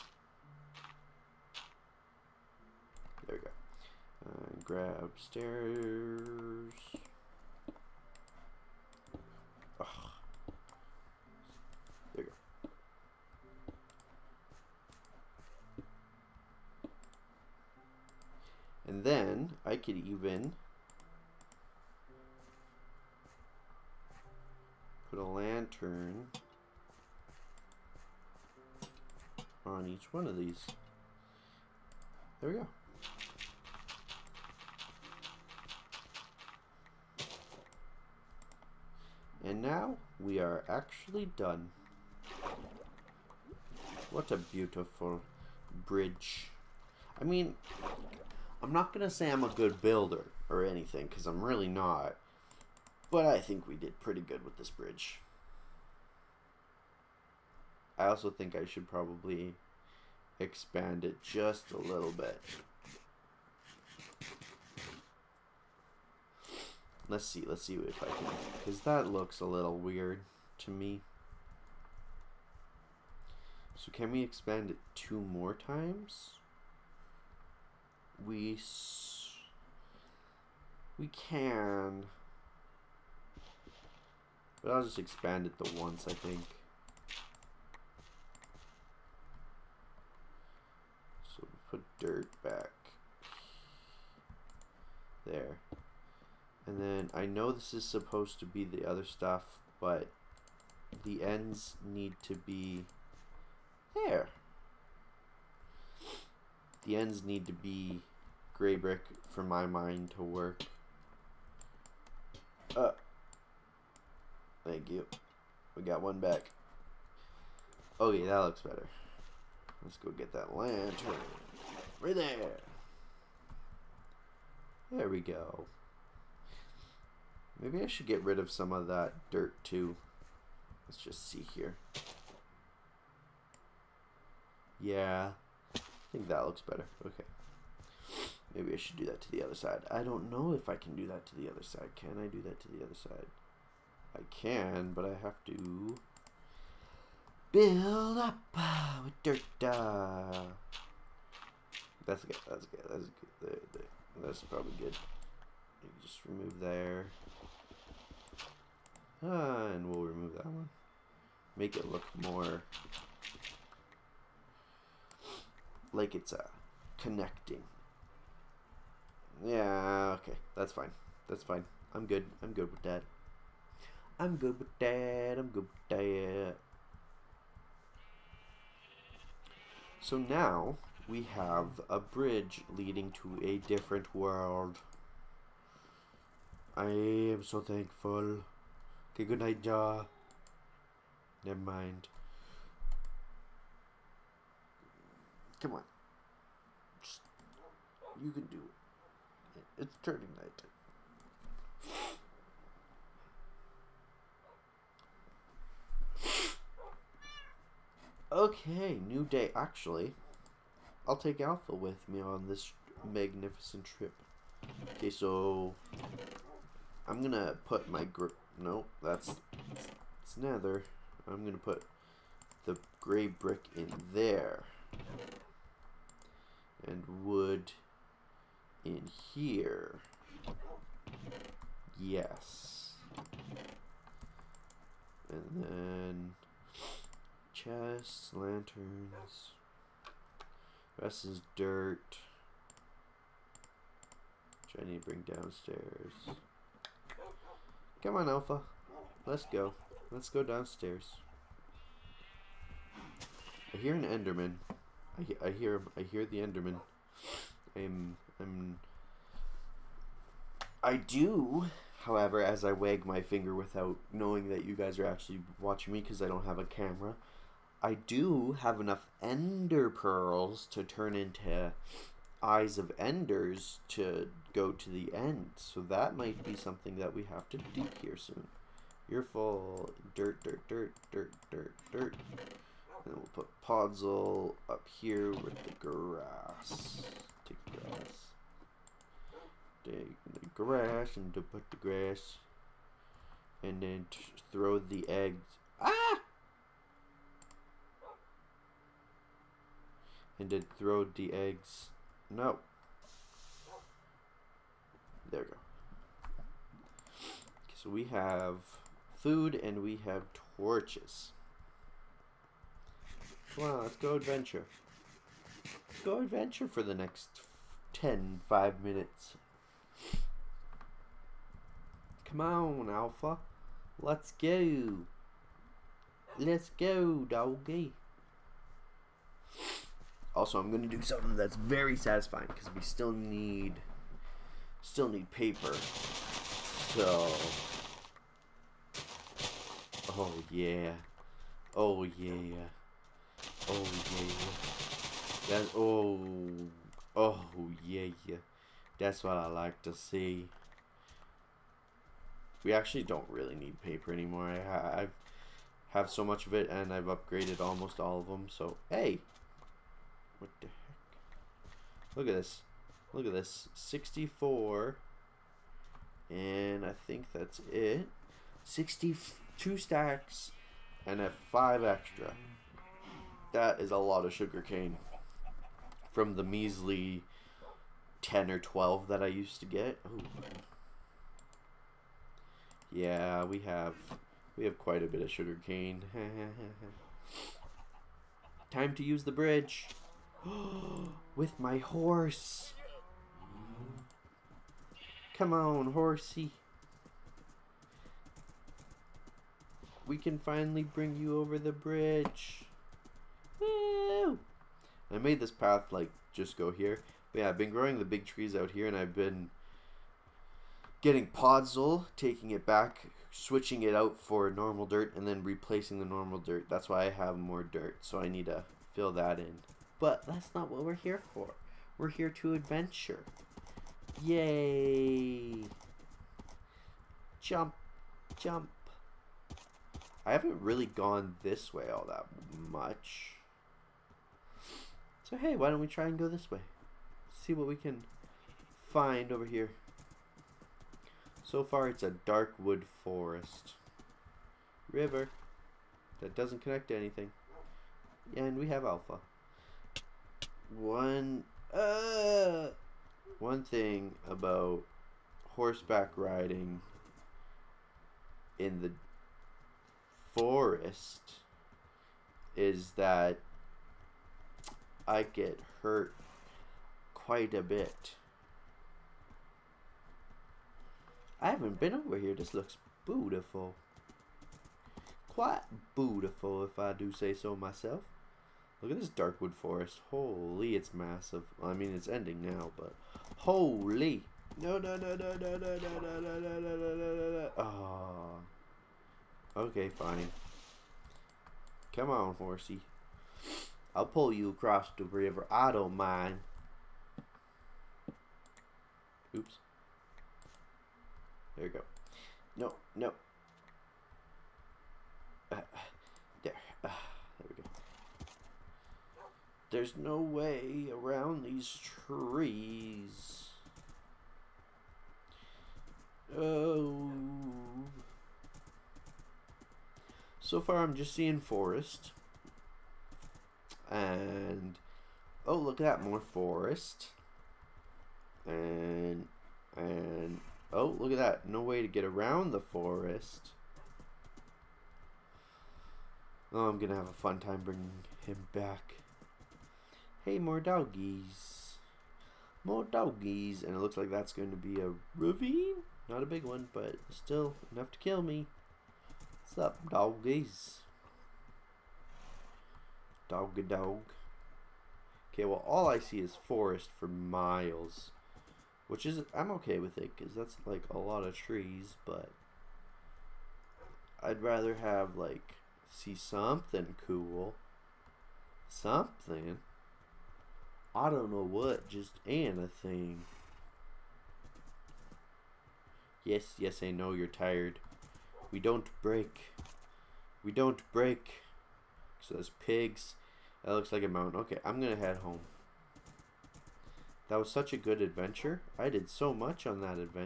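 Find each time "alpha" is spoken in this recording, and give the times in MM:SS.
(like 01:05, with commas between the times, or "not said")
03:31, 04:08, 05:22, 07:28.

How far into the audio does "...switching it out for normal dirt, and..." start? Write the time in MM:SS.
06:53.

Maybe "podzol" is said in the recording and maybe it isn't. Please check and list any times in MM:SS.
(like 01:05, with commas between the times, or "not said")
04:43, 06:51.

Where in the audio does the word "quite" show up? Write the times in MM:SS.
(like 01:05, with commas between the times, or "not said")
06:24, 07:47, 07:55.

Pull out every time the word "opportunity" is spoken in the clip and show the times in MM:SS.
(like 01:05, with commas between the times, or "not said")
not said.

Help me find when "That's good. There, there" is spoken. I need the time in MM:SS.
02:32.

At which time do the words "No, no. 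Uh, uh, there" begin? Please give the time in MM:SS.
08:22.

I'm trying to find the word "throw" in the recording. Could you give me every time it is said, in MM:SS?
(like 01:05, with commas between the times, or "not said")
04:54, 05:00.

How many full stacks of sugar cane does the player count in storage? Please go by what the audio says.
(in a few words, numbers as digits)
62.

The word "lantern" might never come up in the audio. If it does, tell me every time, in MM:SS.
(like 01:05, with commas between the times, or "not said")
00:25, 02:00, 03:58.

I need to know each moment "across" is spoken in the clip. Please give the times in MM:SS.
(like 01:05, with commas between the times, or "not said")
08:14.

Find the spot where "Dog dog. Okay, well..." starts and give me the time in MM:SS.
09:13.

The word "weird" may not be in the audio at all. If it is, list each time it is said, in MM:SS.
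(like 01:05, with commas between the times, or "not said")
01:09.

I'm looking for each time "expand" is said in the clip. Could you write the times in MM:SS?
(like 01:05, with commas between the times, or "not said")
01:00, 01:14, 01:24.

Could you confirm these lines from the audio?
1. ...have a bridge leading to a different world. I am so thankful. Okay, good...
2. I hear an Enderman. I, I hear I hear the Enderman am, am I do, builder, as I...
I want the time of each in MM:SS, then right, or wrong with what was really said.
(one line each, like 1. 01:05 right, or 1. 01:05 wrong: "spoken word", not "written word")
1. 03:01 right
2. 04:13 wrong: "however", not "builder".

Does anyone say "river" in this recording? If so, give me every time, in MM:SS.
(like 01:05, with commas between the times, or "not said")
07:24, 08:15.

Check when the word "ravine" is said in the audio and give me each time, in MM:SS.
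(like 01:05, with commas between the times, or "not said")
09:05.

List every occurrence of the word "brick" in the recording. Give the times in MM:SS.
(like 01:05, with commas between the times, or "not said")
01:48, 03:43.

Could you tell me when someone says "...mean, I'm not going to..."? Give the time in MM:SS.
00:47.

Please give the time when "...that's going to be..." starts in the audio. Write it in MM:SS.
09:04.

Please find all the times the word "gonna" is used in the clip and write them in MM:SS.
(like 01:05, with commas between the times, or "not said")
03:37, 03:41, 08:56.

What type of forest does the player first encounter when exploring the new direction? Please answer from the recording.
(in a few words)
Dark wood forest.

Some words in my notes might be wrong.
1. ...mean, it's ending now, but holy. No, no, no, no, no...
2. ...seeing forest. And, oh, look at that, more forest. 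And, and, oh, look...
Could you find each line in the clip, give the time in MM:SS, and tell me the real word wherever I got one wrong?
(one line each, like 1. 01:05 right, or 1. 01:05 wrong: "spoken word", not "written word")
1. 08:01 right
2. 08:41 right.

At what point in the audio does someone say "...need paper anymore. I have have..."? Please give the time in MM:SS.
05:53.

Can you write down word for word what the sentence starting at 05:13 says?
Come on, let's go adventure go adventure for the next 10, 5 minutes.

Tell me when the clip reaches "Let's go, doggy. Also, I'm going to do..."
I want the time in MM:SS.
05:26.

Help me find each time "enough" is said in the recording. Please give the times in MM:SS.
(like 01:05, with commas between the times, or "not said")
04:28, 09:07.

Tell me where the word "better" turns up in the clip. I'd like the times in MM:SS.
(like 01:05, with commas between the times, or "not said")
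01:58, 02:16.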